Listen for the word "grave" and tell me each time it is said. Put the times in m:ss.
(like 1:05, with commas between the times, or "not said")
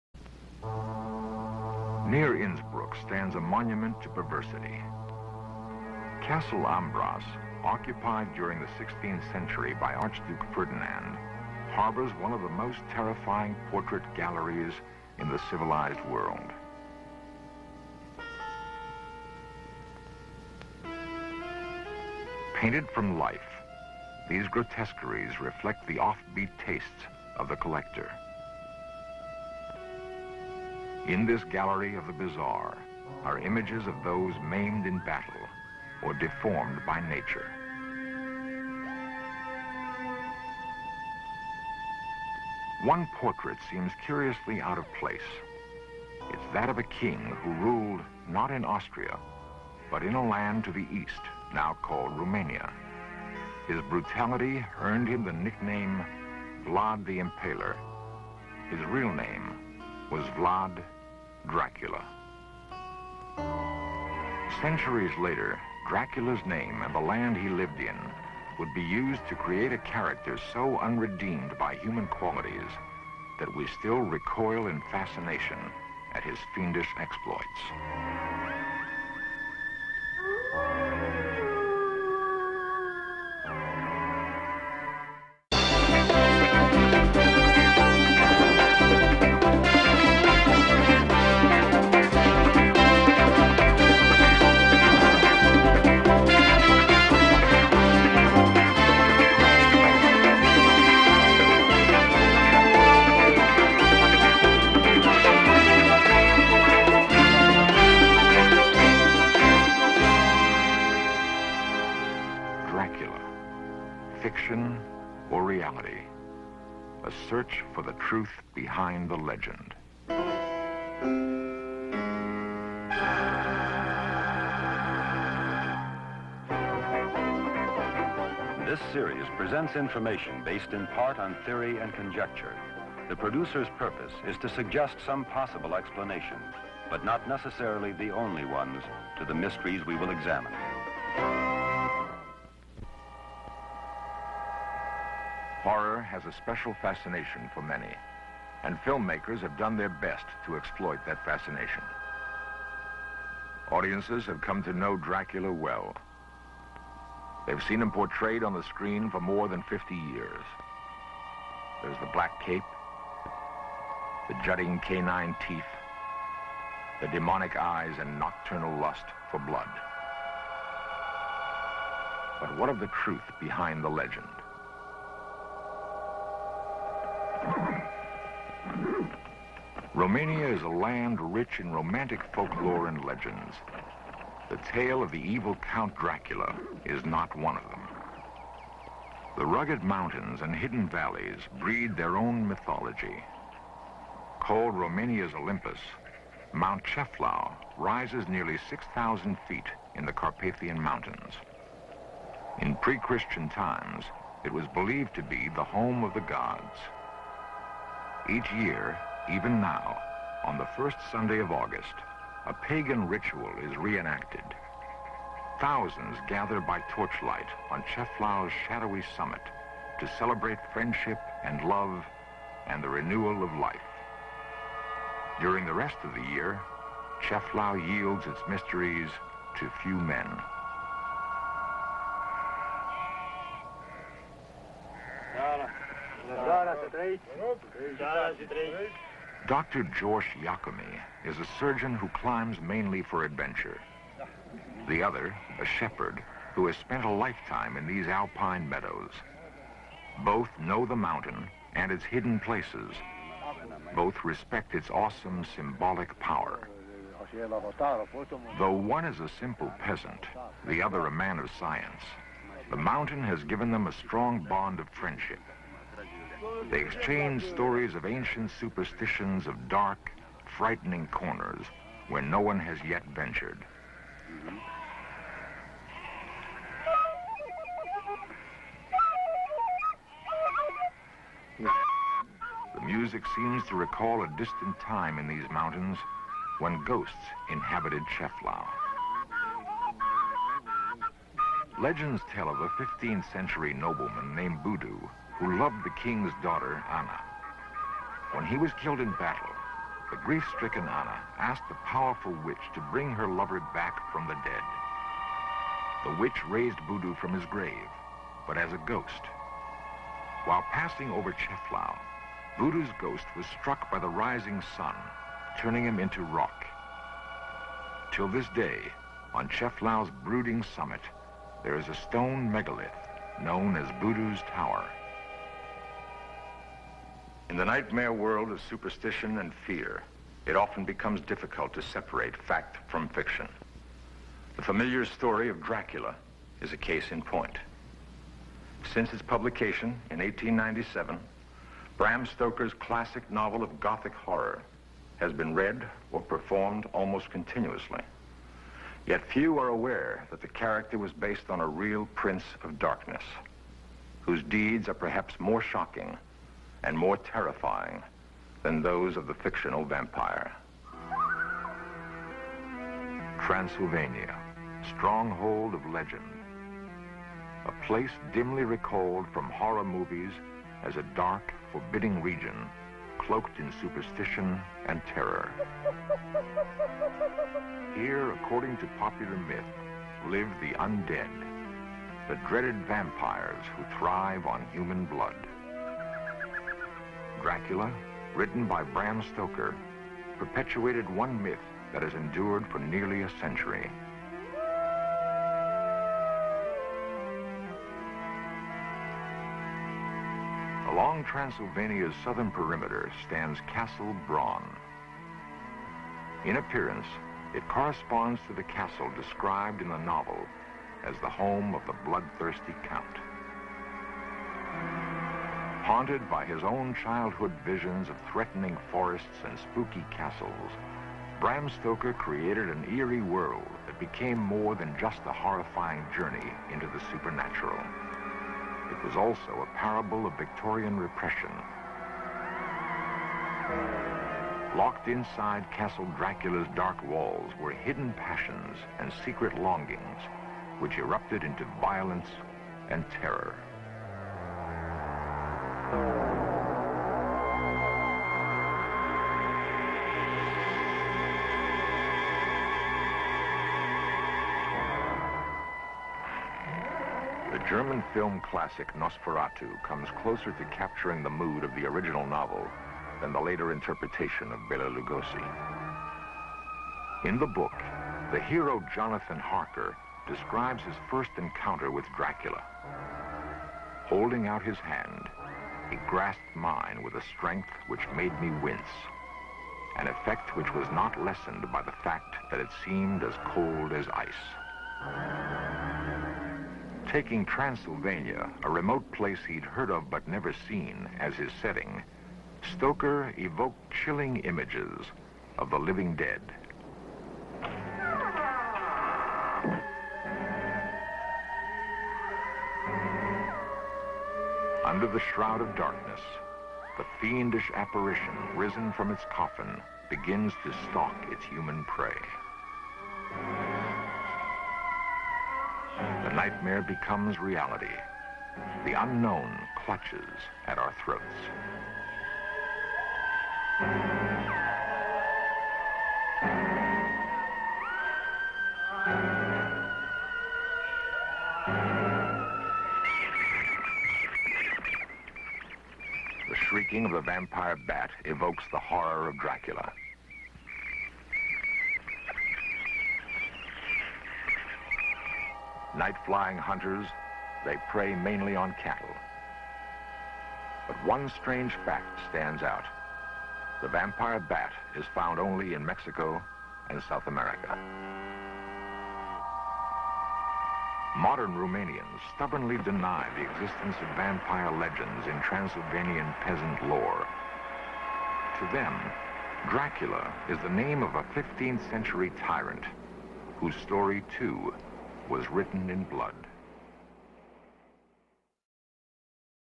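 5:07.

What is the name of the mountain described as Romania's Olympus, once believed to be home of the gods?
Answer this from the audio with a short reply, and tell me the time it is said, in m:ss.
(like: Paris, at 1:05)
Mount Ceahlău, at 3:16.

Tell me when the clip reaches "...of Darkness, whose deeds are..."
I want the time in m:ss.
5:52.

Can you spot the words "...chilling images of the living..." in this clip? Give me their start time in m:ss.
8:13.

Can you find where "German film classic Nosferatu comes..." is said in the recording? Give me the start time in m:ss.
7:37.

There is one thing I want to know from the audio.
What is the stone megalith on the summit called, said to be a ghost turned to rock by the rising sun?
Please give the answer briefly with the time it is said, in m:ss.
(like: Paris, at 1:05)
Budu's Tower, at 5:24.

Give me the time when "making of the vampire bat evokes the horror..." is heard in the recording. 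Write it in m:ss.
8:56.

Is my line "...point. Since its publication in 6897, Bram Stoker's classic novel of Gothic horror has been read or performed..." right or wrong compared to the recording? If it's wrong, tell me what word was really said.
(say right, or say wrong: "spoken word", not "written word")
wrong: "1897", not "6897".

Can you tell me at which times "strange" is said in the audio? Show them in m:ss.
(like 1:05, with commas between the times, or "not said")
9:11.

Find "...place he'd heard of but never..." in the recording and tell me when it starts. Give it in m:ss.
8:09.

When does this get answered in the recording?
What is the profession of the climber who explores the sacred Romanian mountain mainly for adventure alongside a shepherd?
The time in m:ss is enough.
4:01.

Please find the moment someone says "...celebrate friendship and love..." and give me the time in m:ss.
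3:40.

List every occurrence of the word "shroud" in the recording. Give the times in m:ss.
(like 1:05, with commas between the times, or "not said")
8:25.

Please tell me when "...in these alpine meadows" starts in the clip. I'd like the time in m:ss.
4:07.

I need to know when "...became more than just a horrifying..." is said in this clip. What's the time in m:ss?
7:03.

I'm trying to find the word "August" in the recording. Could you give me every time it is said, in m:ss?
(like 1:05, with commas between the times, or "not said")
3:31.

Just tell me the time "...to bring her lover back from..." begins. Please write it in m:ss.
5:02.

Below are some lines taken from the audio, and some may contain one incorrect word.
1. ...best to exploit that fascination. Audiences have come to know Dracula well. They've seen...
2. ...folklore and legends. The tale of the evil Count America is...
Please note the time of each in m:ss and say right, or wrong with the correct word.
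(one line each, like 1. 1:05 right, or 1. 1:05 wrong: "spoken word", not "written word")
1. 2:29 right
2. 3:02 wrong: "Dracula", not "America".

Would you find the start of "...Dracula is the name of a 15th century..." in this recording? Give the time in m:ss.
9:29.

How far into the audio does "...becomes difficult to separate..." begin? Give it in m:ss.
5:30.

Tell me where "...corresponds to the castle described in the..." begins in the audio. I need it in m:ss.
6:47.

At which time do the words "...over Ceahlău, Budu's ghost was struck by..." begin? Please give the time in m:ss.
5:11.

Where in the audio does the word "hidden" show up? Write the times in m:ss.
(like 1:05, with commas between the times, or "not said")
3:10, 4:12, 7:17.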